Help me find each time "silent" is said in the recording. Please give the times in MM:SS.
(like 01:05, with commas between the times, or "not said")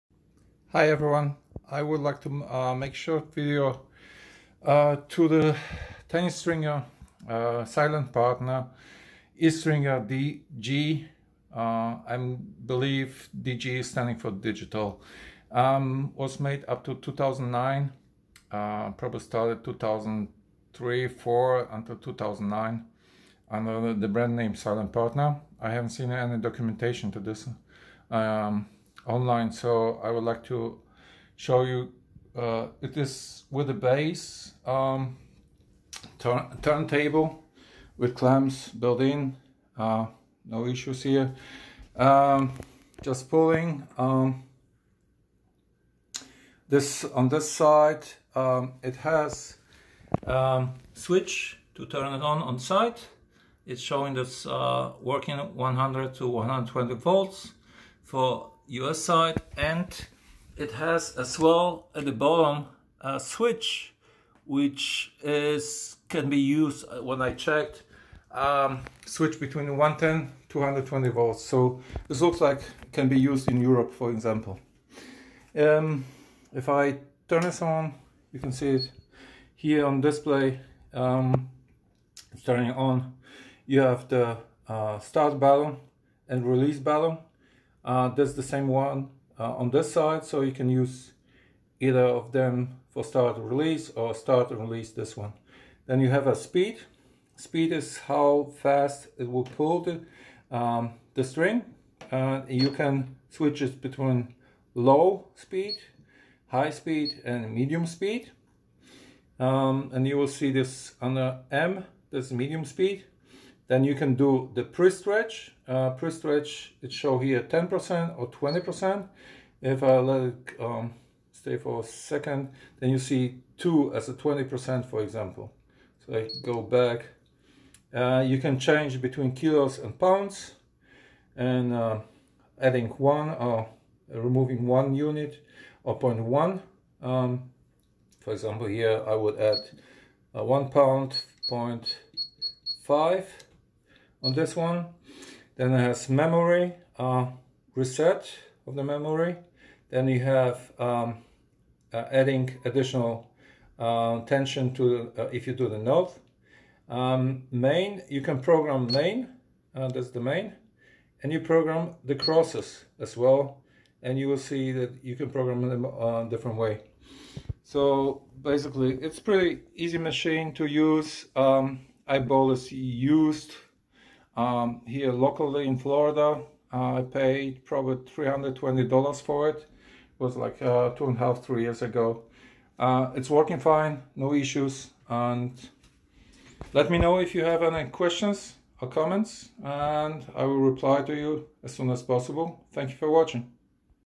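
00:07, 00:24.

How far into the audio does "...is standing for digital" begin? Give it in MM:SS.
00:13.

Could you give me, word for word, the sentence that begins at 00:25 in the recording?
I haven't seen any documentation to this.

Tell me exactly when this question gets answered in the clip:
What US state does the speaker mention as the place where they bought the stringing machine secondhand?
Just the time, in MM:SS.
02:55.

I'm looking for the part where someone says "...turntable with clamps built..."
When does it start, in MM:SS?
00:36.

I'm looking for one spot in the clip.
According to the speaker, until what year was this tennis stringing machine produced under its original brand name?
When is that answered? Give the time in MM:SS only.
00:21.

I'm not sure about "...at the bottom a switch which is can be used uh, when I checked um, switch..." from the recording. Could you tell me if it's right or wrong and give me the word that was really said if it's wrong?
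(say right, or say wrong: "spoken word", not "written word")
right.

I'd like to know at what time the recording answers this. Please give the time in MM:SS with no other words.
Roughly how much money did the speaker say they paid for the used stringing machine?
02:57.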